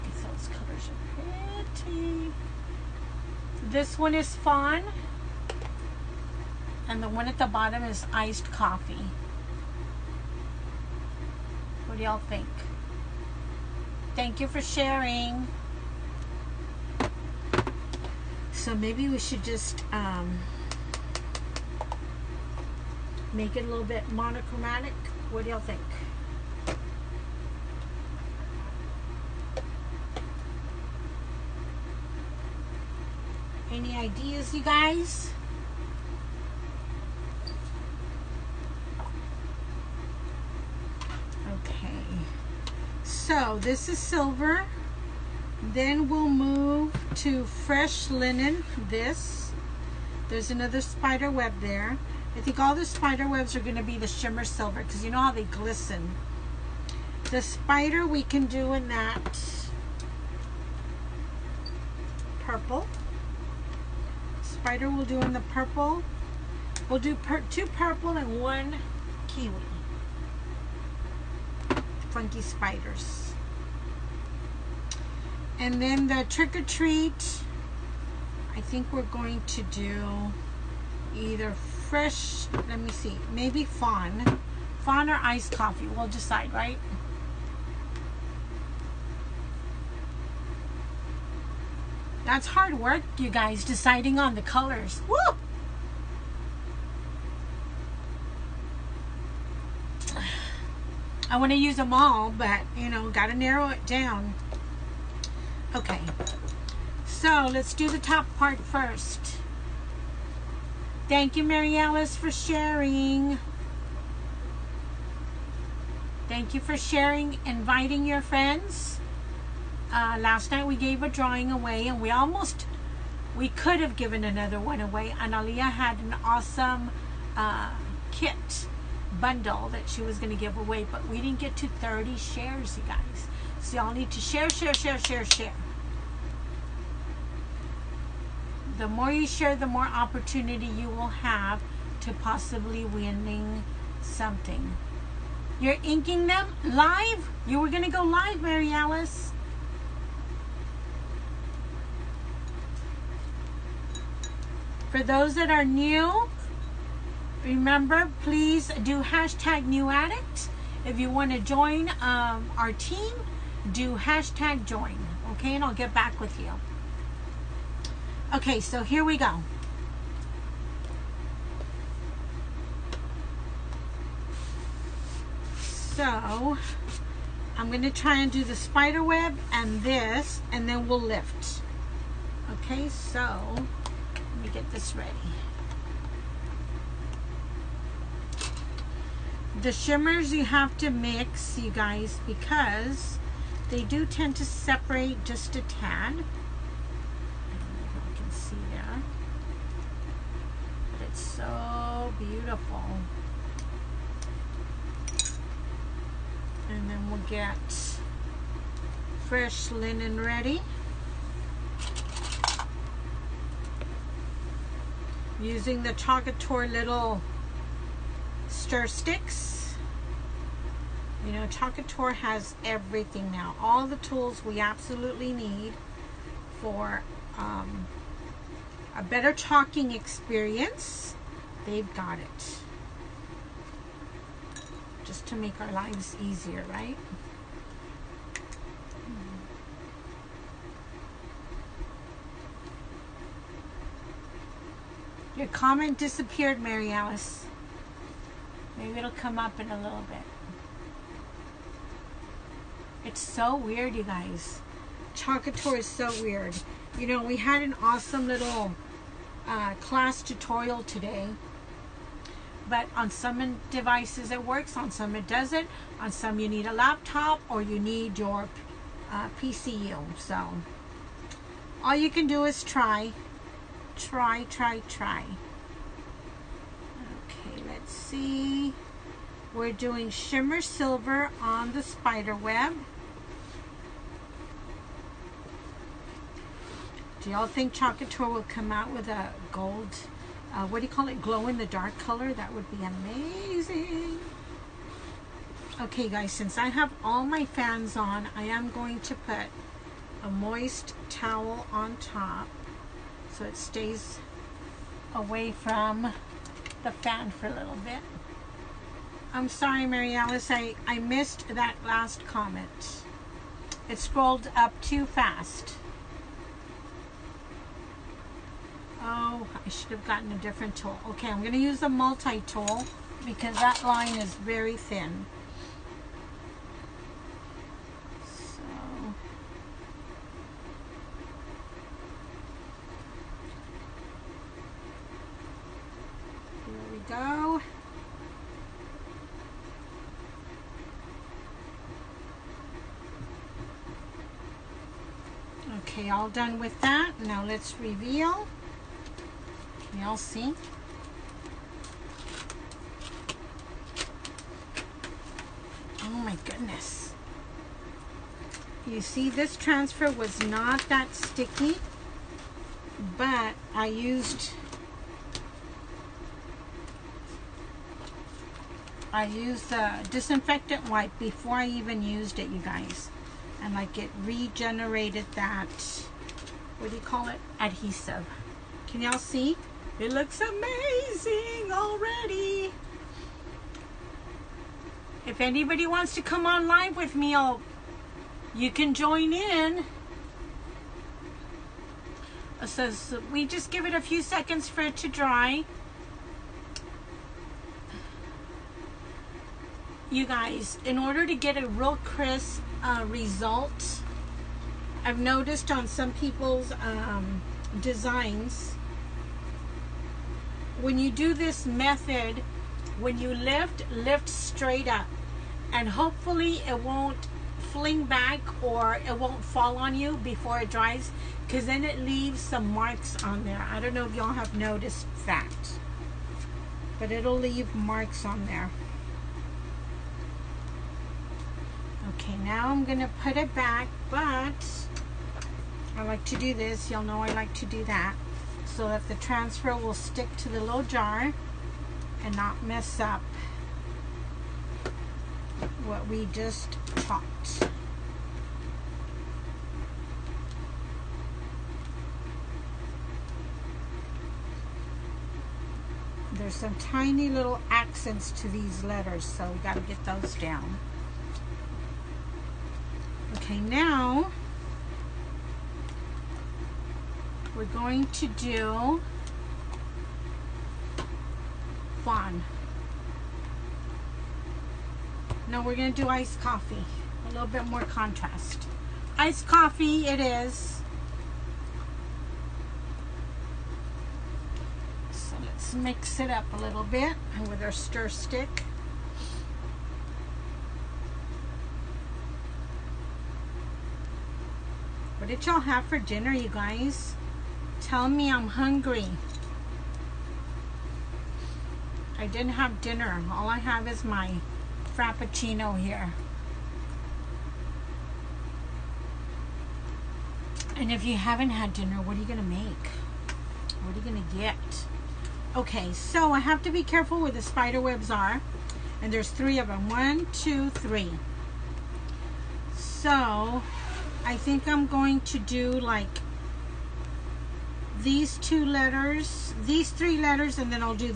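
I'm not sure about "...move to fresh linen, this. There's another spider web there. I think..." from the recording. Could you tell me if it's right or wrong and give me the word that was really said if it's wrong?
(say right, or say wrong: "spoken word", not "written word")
right.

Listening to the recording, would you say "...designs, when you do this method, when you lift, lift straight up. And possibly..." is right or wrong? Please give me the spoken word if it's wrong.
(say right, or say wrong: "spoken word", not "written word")
wrong: "hopefully", not "possibly".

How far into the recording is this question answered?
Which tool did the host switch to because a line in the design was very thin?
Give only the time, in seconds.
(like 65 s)
321 s.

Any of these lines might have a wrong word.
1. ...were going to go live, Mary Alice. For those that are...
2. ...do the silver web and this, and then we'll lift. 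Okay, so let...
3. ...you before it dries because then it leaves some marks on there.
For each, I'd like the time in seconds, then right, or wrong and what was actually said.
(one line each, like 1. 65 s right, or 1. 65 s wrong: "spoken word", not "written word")
1. 147 s right
2. 178 s wrong: "spider", not "silver"
3. 419 s right.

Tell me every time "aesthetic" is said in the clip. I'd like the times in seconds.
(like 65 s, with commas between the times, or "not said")
not said.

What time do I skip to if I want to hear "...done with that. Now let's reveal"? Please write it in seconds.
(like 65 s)
346 s.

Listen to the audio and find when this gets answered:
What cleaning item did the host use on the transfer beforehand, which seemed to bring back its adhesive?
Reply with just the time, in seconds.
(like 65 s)
370 s.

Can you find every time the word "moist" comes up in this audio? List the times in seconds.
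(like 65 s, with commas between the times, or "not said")
300 s.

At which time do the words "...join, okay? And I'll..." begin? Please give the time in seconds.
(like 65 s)
164 s.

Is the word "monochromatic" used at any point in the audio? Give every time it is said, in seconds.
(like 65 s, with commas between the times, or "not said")
24 s.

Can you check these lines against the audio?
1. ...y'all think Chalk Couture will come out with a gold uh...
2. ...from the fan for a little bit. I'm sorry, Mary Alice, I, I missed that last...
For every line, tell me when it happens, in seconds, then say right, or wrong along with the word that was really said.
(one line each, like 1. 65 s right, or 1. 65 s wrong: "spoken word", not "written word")
1. 287 s right
2. 305 s right.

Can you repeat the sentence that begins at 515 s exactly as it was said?
Okay, so I have to be careful where the spider webs are.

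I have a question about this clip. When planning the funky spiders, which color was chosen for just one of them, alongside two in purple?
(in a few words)
kiwi.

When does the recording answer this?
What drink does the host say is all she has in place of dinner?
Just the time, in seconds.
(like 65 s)
504 s.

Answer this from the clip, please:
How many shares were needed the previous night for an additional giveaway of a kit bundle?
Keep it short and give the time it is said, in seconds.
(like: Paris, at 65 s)
30, at 131 s.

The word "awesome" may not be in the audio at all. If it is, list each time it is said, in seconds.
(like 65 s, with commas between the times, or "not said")
126 s, 257 s.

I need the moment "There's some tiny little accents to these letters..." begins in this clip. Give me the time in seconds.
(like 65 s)
456 s.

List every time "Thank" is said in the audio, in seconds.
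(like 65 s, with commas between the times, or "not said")
14 s, 111 s, 116 s.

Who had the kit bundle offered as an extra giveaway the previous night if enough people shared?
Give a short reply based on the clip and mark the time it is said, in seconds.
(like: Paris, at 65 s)
Analia, at 125 s.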